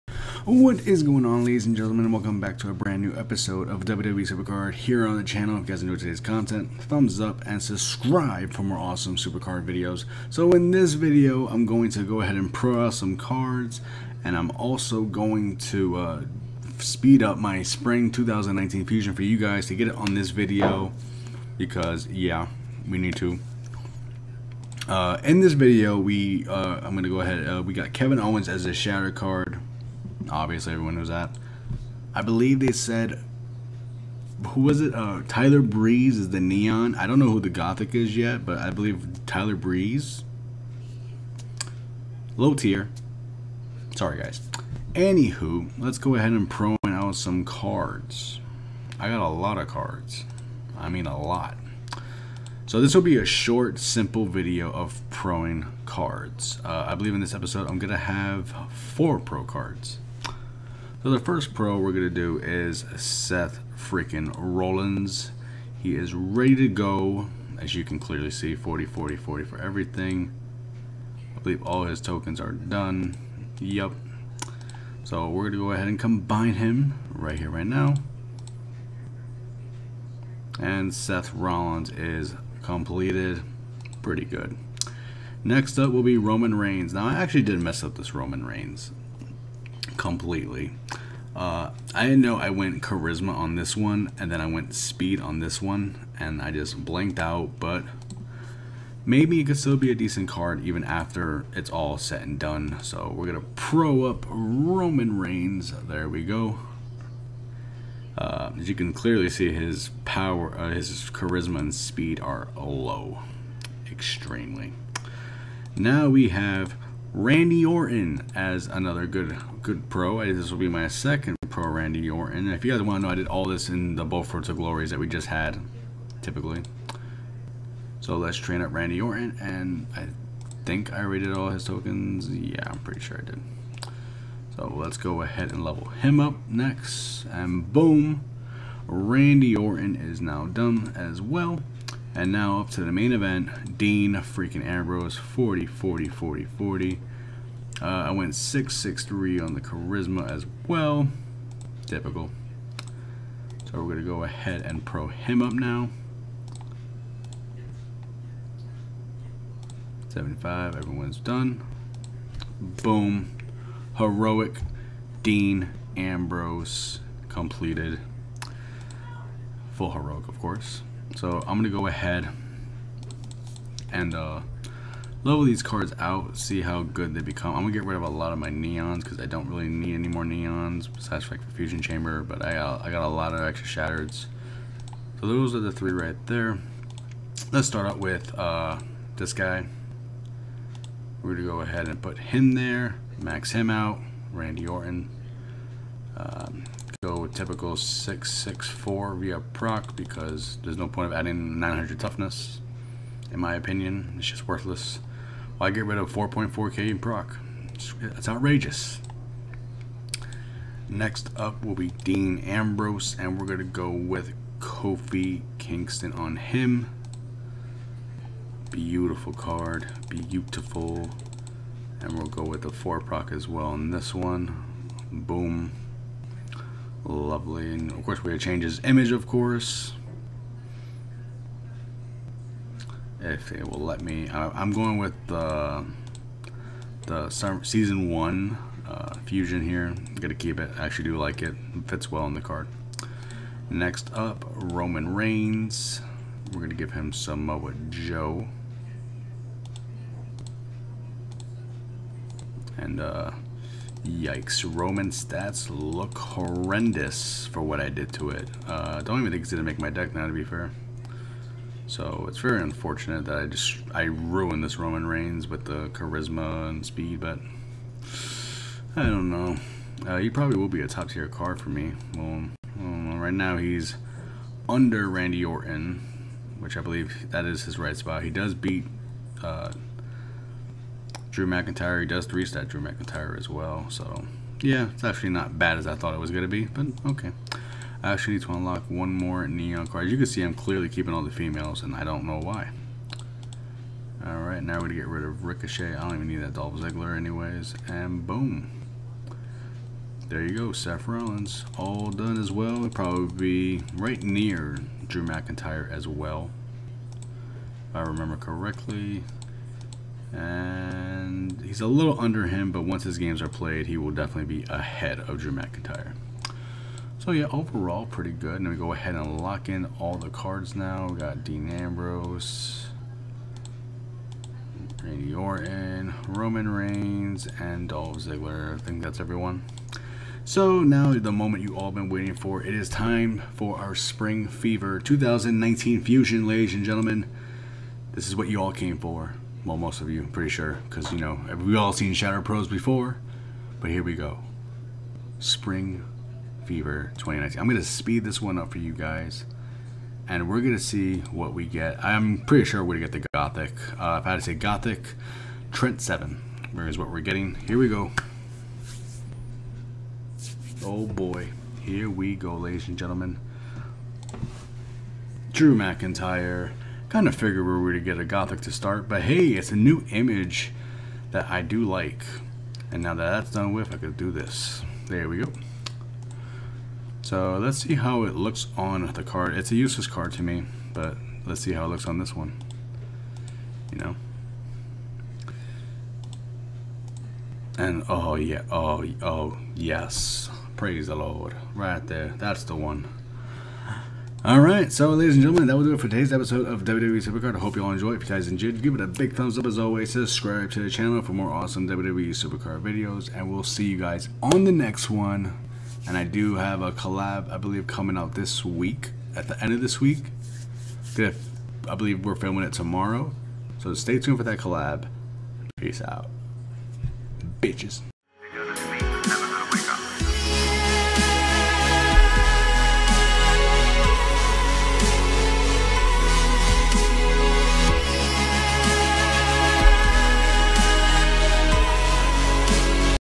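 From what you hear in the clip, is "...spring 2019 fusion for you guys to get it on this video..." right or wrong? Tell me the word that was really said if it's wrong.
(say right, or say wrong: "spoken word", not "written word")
right.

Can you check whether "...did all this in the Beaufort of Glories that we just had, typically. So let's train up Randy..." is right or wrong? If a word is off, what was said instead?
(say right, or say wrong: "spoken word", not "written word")
right.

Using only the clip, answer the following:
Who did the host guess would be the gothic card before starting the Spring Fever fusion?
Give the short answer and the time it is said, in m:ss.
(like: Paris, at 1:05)
Trent 7, at 5:55.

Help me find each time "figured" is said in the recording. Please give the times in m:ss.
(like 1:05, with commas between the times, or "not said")
6:07.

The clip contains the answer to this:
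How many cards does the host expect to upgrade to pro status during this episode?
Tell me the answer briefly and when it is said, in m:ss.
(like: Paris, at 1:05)
4, at 0:58.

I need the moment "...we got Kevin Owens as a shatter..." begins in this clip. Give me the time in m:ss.
0:27.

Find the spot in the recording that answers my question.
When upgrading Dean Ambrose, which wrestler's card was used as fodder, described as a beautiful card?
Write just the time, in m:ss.
3:34.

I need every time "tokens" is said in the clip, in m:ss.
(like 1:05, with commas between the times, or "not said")
1:12, 2:11.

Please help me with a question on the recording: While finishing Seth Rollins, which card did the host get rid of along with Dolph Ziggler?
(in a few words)
Ricochet.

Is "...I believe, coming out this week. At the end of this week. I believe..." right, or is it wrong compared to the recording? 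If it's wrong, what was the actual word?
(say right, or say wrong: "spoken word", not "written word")
right.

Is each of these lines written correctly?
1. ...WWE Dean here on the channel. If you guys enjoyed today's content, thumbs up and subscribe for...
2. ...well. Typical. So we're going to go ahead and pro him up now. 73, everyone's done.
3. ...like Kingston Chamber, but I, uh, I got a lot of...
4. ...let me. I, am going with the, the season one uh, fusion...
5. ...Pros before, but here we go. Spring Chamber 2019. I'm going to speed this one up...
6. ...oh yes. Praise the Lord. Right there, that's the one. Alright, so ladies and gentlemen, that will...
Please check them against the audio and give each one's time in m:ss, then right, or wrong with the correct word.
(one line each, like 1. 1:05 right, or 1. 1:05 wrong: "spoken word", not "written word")
1. 0:03 wrong: "Supercard", not "Dean"
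2. 2:30 wrong: "75", not "73"
3. 3:01 wrong: "Fusion", not "Kingston"
4. 3:53 right
5. 5:42 wrong: "Fever", not "Chamber"
6. 6:29 right.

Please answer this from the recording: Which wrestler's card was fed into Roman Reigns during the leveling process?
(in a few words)
Samoa Joe.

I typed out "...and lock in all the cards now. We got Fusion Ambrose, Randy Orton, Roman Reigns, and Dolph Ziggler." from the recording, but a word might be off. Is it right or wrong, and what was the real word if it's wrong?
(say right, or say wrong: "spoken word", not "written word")
wrong: "Dean", not "Fusion".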